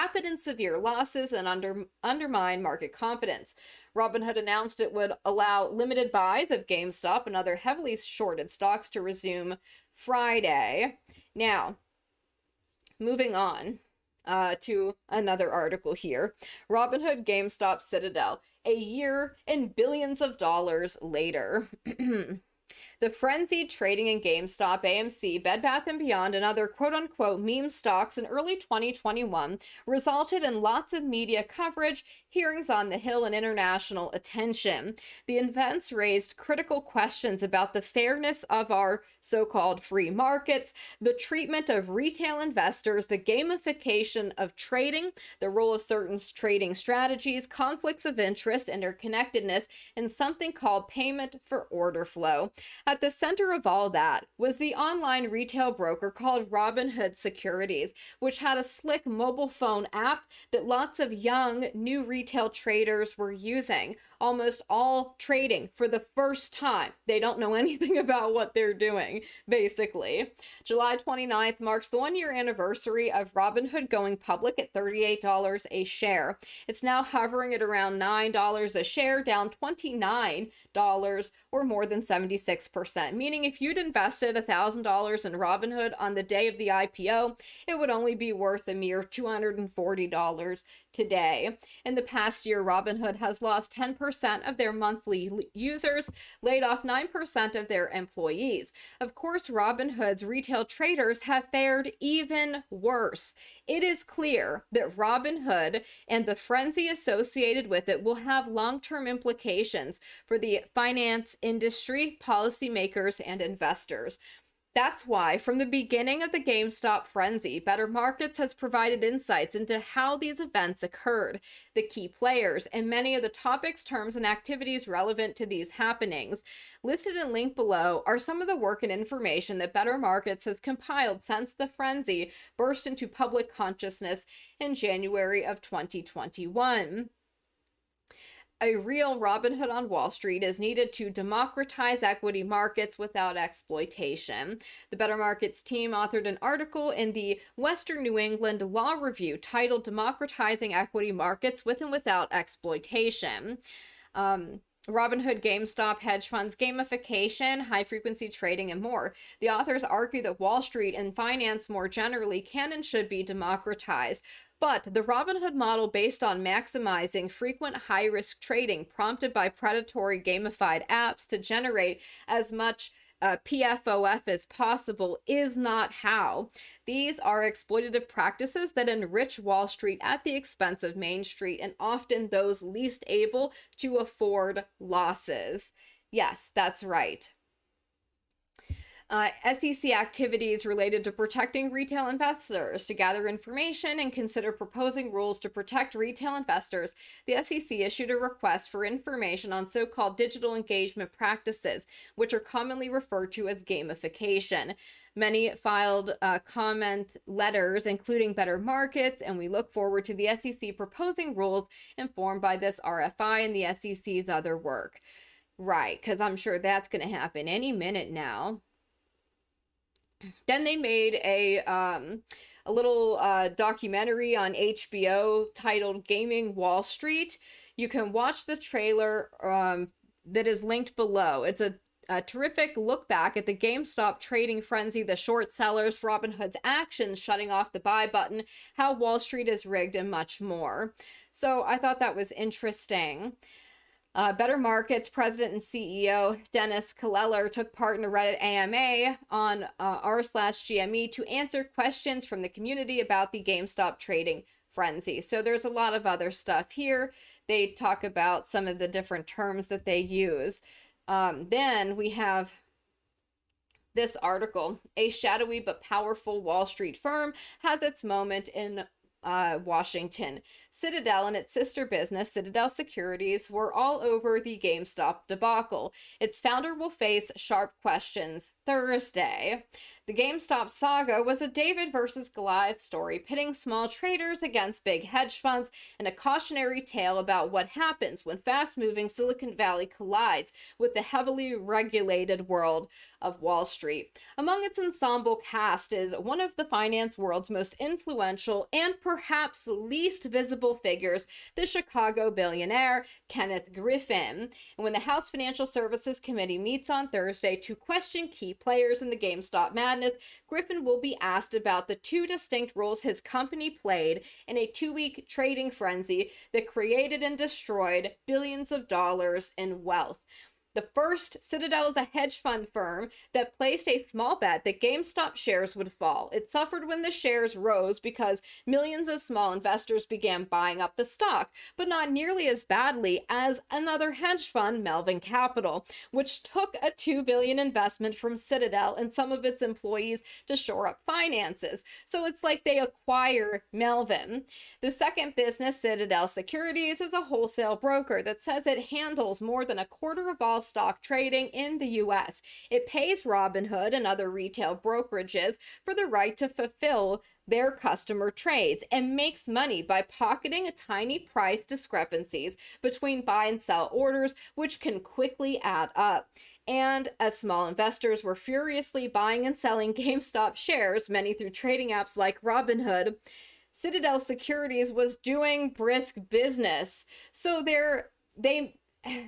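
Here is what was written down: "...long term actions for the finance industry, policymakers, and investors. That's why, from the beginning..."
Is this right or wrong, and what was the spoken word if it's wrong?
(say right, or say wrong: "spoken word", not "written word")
wrong: "implications", not "actions".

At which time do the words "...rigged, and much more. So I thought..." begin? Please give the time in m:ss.
3:59.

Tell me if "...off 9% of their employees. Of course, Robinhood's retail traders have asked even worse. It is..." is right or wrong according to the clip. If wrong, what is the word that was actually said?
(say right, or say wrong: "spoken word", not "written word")
wrong: "fared", not "asked".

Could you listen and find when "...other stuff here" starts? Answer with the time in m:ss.
4:16.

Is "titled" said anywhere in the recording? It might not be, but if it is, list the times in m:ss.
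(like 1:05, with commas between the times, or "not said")
2:29, 3:45.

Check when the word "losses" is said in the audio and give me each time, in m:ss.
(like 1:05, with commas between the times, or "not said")
0:00, 3:04.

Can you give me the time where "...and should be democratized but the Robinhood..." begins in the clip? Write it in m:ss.
2:42.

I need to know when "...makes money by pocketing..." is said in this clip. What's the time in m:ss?
5:59.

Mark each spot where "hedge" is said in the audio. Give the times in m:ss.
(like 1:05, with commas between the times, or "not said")
2:36, 4:45, 5:22, 5:34.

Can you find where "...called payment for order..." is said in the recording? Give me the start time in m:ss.
0:50.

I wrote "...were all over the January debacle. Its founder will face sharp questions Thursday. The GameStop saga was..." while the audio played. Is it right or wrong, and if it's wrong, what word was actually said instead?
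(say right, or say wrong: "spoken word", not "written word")
wrong: "GameStop", not "January".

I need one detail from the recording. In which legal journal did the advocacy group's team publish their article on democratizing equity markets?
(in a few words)
Western New England Law Review.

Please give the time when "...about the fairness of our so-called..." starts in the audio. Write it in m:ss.
0:37.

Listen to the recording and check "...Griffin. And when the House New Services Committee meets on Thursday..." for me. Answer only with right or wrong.
wrong.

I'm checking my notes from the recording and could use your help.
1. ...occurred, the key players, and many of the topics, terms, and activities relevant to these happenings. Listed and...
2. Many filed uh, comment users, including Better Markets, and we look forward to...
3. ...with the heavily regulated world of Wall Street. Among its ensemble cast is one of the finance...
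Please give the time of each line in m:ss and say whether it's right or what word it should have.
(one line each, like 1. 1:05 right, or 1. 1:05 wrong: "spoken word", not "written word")
1. 2:00 right
2. 3:25 wrong: "letters", not "users"
3. 4:50 right.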